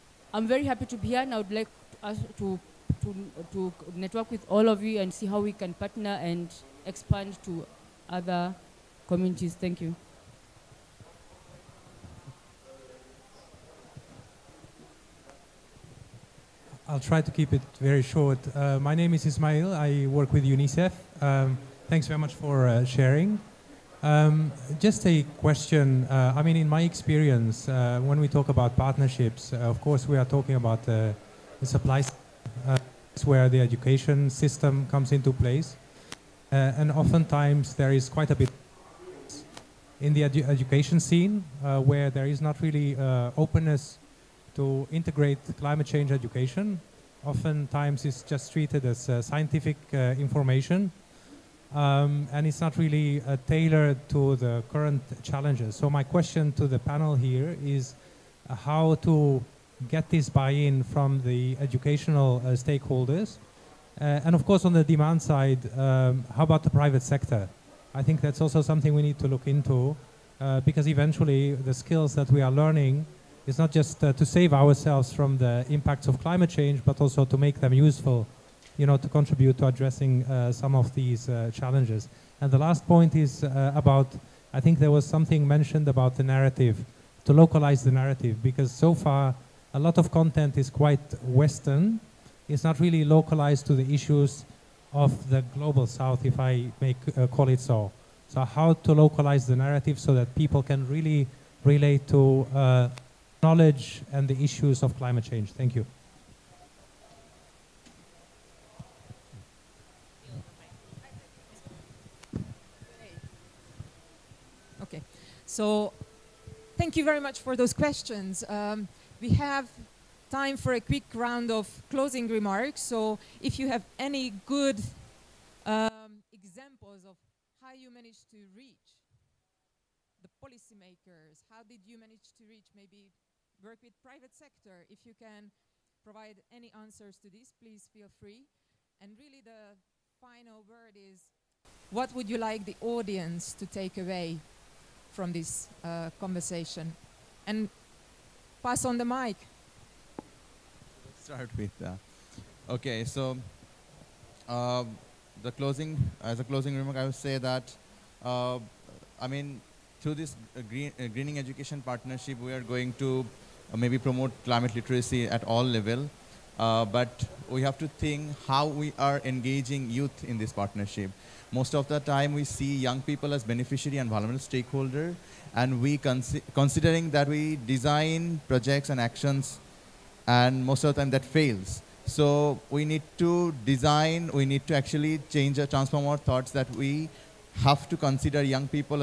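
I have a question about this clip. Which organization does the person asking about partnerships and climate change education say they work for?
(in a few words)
UNICEF.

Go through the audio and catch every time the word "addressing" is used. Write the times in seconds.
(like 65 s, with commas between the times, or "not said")
79 s.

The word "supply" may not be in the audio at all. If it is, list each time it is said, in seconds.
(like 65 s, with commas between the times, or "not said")
31 s.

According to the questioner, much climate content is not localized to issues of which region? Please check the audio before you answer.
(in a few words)
the global South.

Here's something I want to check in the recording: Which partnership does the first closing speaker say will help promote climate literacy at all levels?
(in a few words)
greening education partnership.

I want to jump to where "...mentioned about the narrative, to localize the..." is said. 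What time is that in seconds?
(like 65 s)
85 s.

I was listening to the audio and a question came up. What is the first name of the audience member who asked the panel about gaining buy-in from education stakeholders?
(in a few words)
Ismail.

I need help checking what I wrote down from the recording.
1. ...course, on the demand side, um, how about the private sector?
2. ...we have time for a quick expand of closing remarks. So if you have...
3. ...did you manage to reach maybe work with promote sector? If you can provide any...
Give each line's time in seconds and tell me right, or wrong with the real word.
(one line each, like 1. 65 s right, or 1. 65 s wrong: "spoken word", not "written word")
1. 64 s right
2. 119 s wrong: "round", not "expand"
3. 131 s wrong: "private", not "promote".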